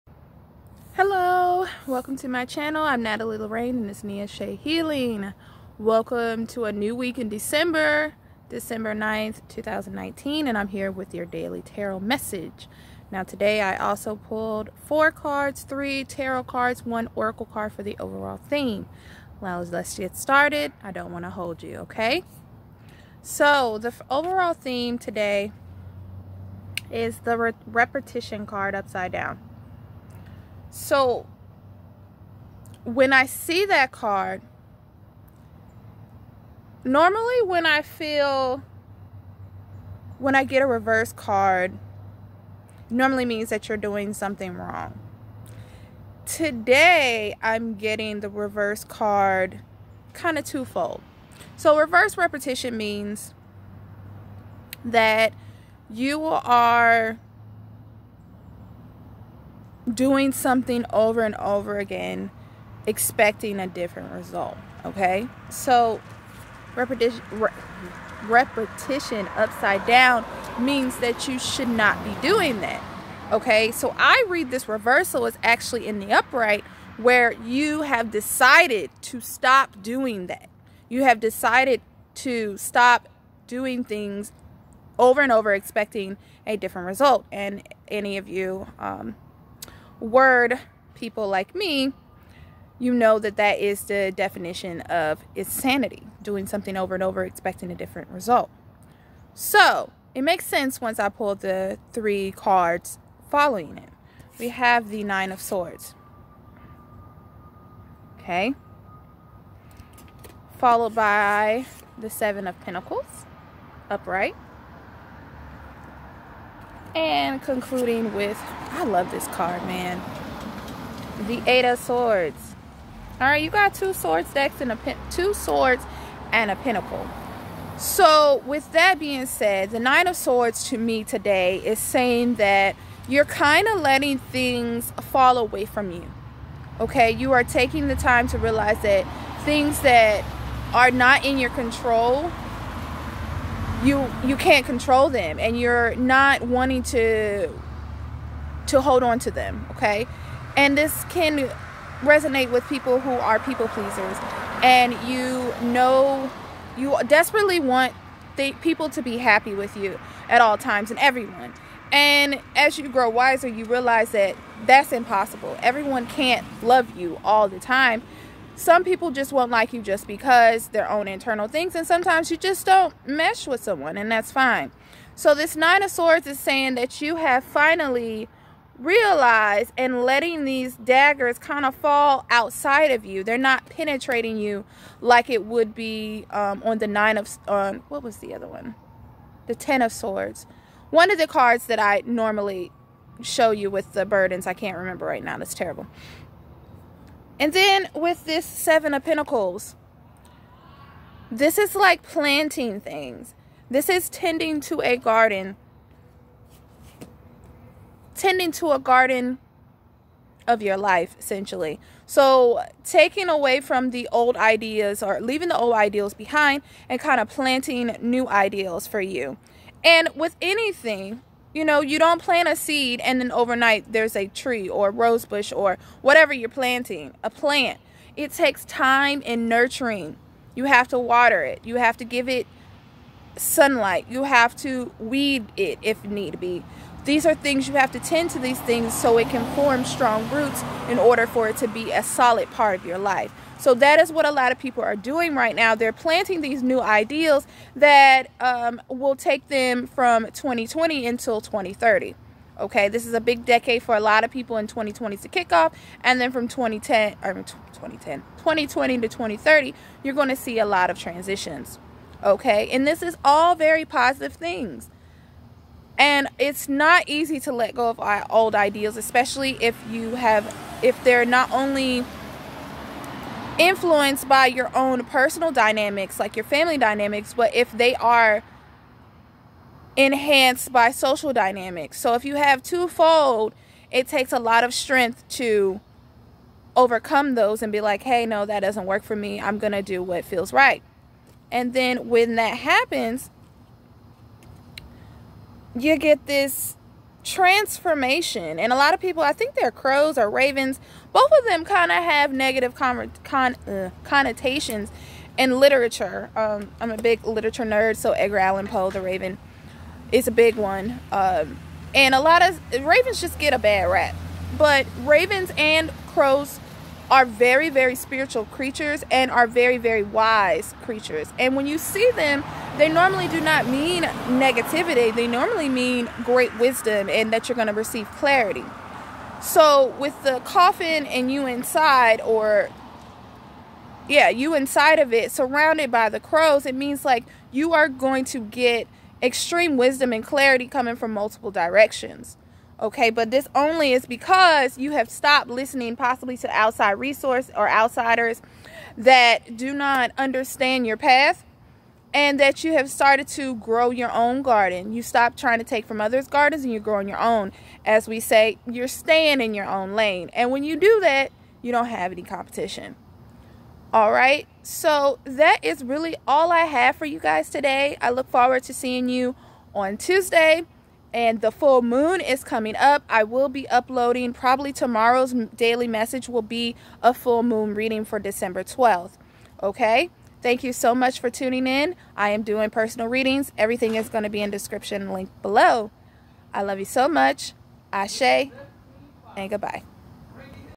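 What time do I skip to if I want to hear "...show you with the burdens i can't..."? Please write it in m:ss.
3:13.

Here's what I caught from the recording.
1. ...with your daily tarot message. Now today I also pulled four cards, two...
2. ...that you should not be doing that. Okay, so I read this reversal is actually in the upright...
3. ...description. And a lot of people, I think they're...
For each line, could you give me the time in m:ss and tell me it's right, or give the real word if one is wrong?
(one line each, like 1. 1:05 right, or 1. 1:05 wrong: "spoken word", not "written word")
1. 0:10 wrong: "three", not "two"
2. 1:10 right
3. 4:57 wrong: "transformation", not "description".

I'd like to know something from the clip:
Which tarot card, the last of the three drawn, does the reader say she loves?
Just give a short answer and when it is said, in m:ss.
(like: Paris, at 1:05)
Eight of Swords, at 2:01.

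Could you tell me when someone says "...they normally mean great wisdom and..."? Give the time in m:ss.
5:25.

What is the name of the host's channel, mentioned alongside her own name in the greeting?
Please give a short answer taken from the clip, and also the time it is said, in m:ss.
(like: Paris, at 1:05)
Nia Eshe Healing, at 0:04.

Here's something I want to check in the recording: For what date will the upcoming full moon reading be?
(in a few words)
December 12th.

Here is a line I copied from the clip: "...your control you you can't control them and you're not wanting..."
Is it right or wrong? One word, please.
right.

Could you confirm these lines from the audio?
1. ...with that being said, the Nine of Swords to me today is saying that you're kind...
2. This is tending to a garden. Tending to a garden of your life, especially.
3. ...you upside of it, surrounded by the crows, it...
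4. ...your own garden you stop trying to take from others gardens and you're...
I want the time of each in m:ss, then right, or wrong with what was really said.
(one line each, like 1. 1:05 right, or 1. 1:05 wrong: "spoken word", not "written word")
1. 2:08 right
2. 3:23 wrong: "essentially", not "especially"
3. 5:34 wrong: "inside", not "upside"
4. 5:53 right.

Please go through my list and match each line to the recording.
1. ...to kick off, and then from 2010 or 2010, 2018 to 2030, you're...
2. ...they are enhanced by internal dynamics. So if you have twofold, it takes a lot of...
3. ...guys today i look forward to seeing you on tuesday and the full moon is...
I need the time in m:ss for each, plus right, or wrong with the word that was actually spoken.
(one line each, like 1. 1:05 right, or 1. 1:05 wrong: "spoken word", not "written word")
1. 4:15 wrong: "2020", not "2018"
2. 4:37 wrong: "social", not "internal"
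3. 6:07 right.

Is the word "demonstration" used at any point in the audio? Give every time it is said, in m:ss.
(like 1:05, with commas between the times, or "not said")
not said.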